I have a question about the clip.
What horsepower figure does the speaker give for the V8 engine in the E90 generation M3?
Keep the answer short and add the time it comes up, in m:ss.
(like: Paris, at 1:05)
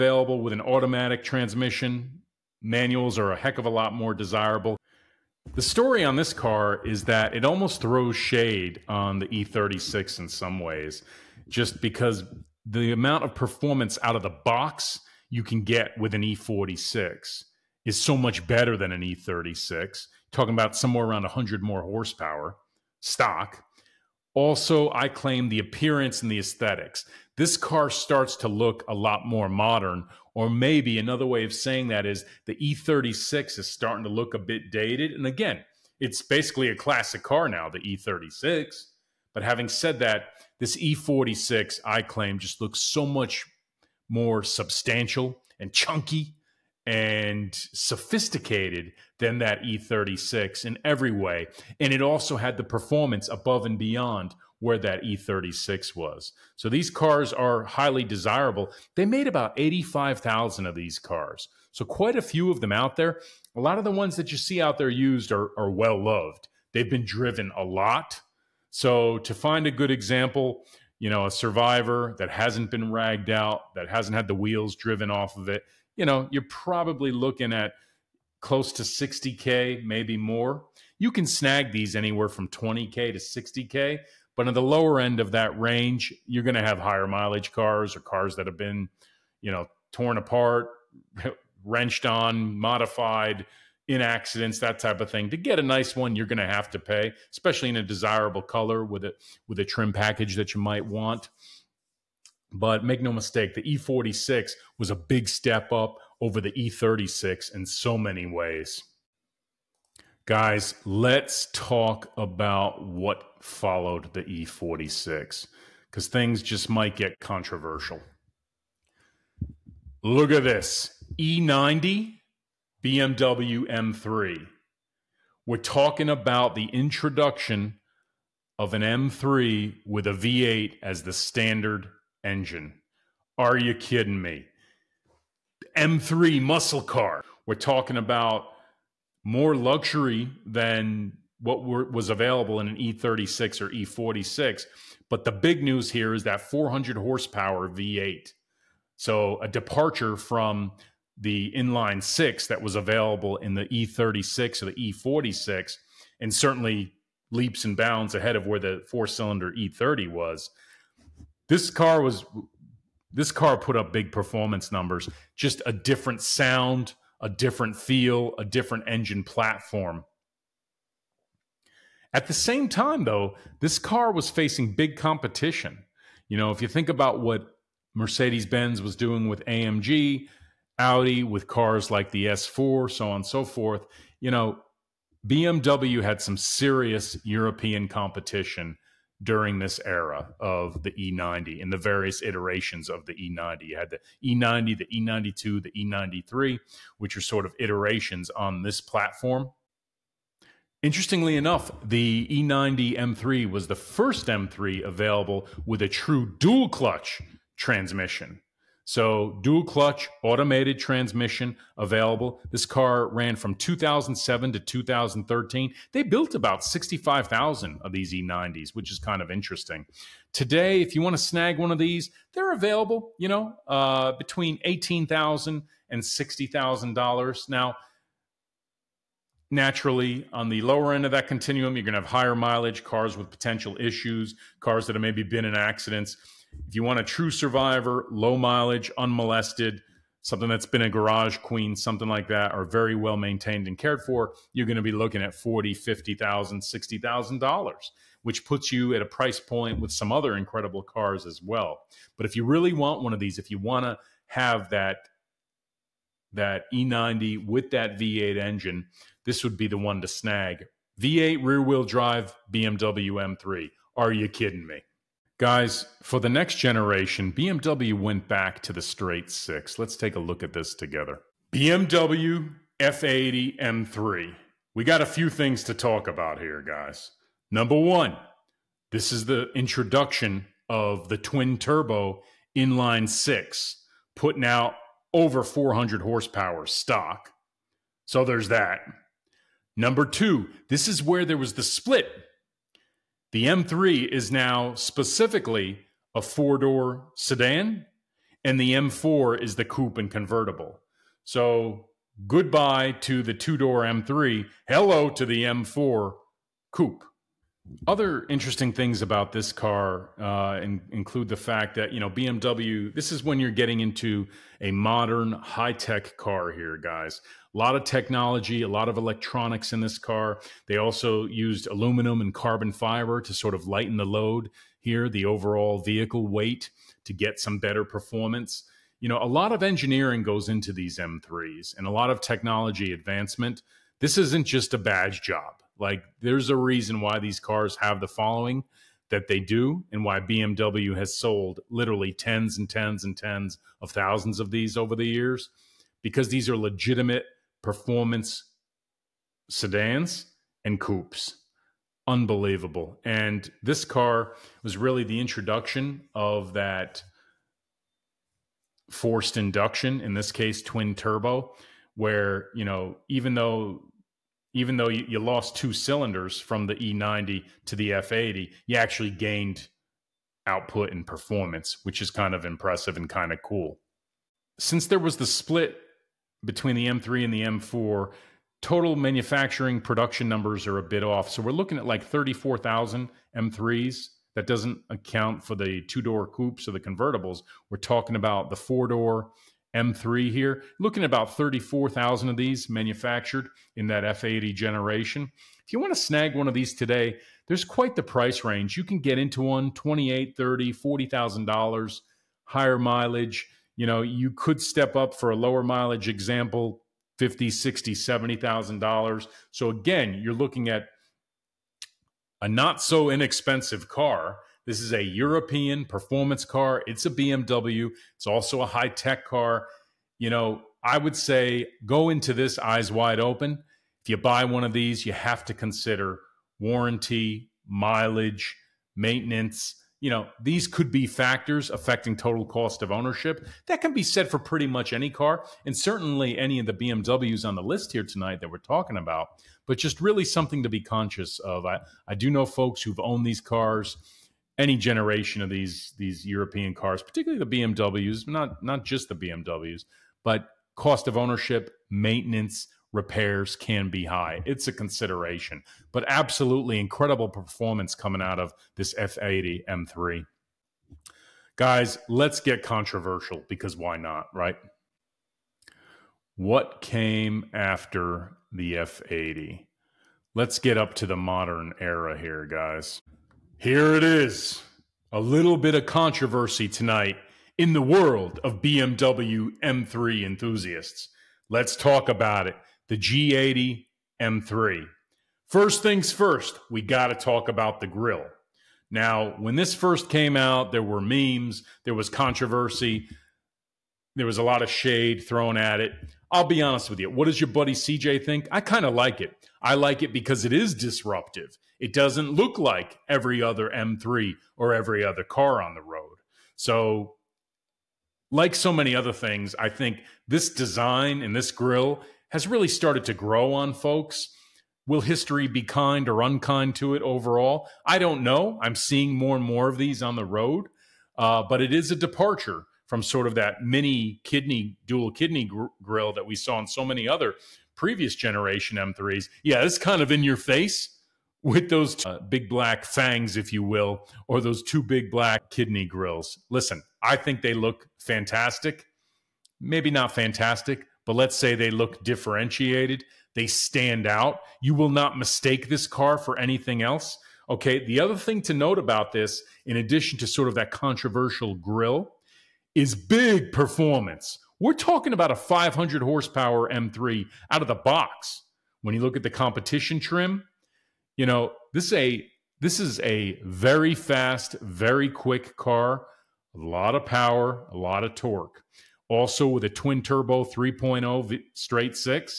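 400, at 2:26.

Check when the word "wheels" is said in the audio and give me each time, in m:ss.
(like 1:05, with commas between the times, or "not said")
1:14, 4:21.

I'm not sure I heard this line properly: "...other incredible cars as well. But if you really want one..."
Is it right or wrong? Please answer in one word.
right.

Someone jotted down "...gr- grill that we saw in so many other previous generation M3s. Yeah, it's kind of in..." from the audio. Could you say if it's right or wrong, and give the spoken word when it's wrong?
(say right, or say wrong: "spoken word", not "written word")
right.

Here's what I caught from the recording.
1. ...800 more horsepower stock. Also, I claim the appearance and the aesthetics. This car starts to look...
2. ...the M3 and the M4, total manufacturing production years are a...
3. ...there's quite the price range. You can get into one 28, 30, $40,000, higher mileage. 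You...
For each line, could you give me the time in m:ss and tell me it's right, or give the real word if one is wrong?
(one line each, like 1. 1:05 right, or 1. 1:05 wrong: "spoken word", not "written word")
1. 0:21 wrong: "100", not "800"
2. 6:16 wrong: "numbers", not "years"
3. 6:37 right.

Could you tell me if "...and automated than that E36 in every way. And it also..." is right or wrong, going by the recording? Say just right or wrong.
wrong.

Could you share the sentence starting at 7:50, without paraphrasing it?
Let's get up to the modern era here, guys.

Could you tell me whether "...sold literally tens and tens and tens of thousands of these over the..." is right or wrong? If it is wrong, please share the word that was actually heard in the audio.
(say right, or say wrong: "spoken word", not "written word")
right.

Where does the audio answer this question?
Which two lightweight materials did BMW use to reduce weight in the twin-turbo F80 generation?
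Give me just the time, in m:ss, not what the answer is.
5:21.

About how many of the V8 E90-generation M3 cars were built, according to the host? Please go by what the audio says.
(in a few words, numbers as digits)
65,000.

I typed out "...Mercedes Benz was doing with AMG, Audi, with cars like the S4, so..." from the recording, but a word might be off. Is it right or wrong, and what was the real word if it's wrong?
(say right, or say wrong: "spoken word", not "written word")
right.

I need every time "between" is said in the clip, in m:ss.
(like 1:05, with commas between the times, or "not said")
3:44, 6:16.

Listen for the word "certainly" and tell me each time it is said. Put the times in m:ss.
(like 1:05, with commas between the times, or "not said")
2:36, 7:15.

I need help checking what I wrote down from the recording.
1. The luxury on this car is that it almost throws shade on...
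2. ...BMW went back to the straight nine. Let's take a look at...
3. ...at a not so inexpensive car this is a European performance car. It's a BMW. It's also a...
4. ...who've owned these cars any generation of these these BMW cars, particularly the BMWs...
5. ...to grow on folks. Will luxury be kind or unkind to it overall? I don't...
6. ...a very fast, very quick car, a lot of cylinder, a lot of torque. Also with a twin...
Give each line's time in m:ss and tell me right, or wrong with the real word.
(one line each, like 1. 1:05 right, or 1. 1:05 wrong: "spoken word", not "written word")
1. 0:05 wrong: "story", not "luxury"
2. 4:27 wrong: "six", not "nine"
3. 6:50 right
4. 7:22 wrong: "European", not "BMW"
5. 8:33 wrong: "history", not "luxury"
6. 9:23 wrong: "power", not "cylinder".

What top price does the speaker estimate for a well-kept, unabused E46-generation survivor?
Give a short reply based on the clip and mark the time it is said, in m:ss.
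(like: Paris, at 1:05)
60K, at 1:18.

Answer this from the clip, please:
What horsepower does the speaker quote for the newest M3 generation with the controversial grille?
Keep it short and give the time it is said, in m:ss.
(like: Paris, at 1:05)
500, at 9:15.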